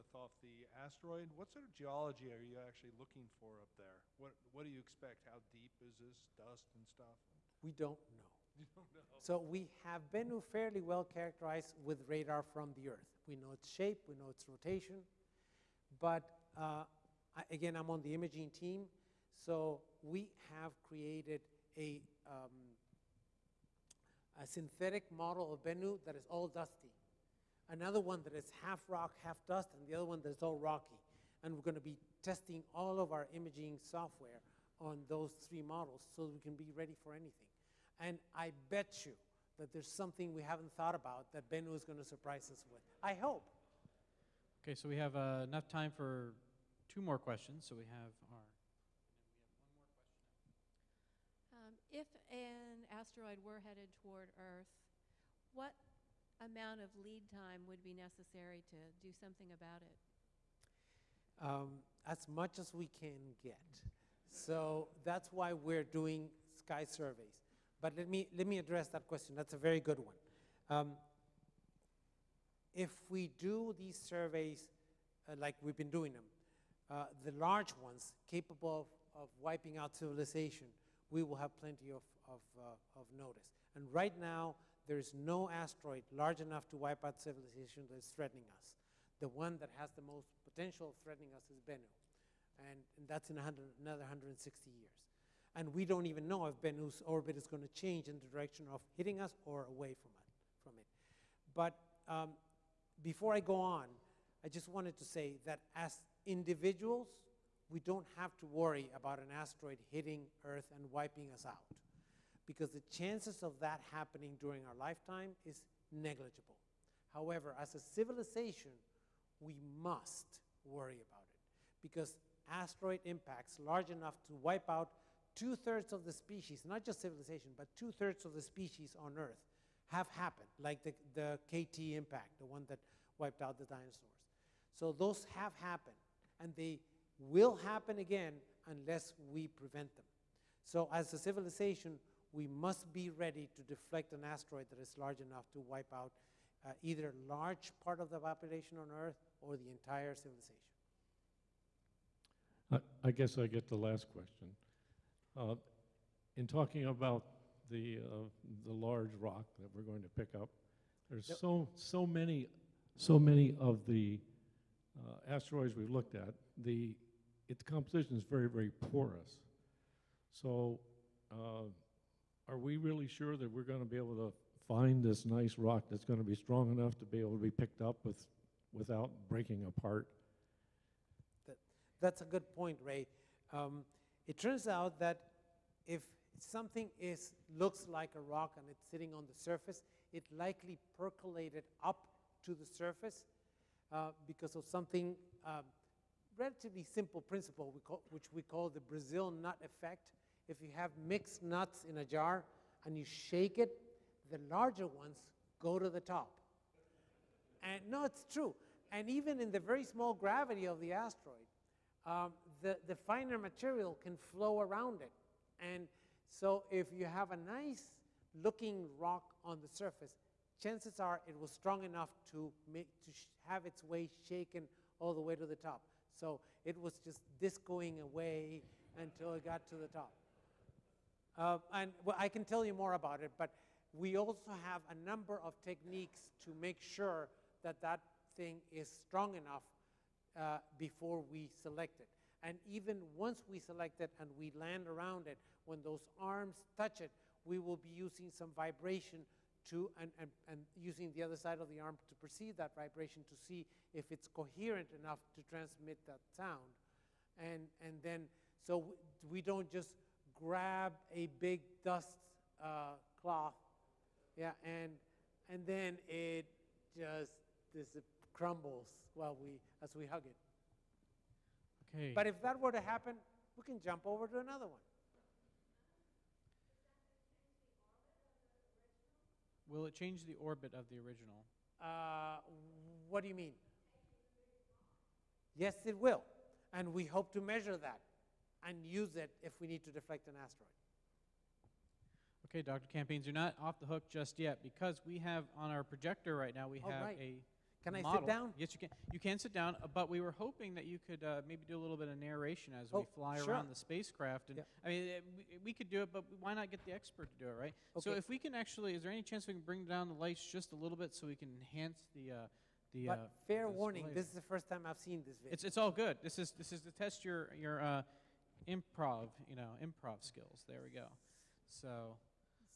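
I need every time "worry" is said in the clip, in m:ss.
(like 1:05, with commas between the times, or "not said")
1:48, 2:00.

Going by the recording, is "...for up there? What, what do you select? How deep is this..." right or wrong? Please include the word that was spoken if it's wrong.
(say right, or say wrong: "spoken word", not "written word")
wrong: "expect", not "select".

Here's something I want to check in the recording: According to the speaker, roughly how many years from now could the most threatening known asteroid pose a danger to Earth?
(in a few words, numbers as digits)
160 years.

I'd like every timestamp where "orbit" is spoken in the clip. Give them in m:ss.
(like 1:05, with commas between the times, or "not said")
1:37, 4:40.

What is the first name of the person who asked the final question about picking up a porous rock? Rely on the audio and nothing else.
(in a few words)
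Ray.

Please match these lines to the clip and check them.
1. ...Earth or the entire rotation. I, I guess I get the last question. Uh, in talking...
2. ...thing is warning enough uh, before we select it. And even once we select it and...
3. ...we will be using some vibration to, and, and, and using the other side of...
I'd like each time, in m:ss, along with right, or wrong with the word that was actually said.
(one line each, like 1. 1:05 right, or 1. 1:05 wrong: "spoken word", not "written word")
1. 2:28 wrong: "civilization", not "rotation"
2. 3:58 wrong: "strong", not "warning"
3. 4:07 right.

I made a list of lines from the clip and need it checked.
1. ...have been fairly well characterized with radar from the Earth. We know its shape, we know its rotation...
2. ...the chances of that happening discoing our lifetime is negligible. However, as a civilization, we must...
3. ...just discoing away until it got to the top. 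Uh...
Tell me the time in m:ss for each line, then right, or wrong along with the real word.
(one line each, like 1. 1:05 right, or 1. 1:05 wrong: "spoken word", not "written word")
1. 0:09 right
2. 1:52 wrong: "during", not "discoing"
3. 3:47 right.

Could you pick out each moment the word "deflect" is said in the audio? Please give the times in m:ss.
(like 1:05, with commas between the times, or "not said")
2:23, 4:49.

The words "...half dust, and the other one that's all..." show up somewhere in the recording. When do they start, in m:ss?
0:29.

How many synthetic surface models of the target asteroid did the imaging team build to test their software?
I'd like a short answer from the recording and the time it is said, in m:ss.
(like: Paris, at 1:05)
3, at 0:35.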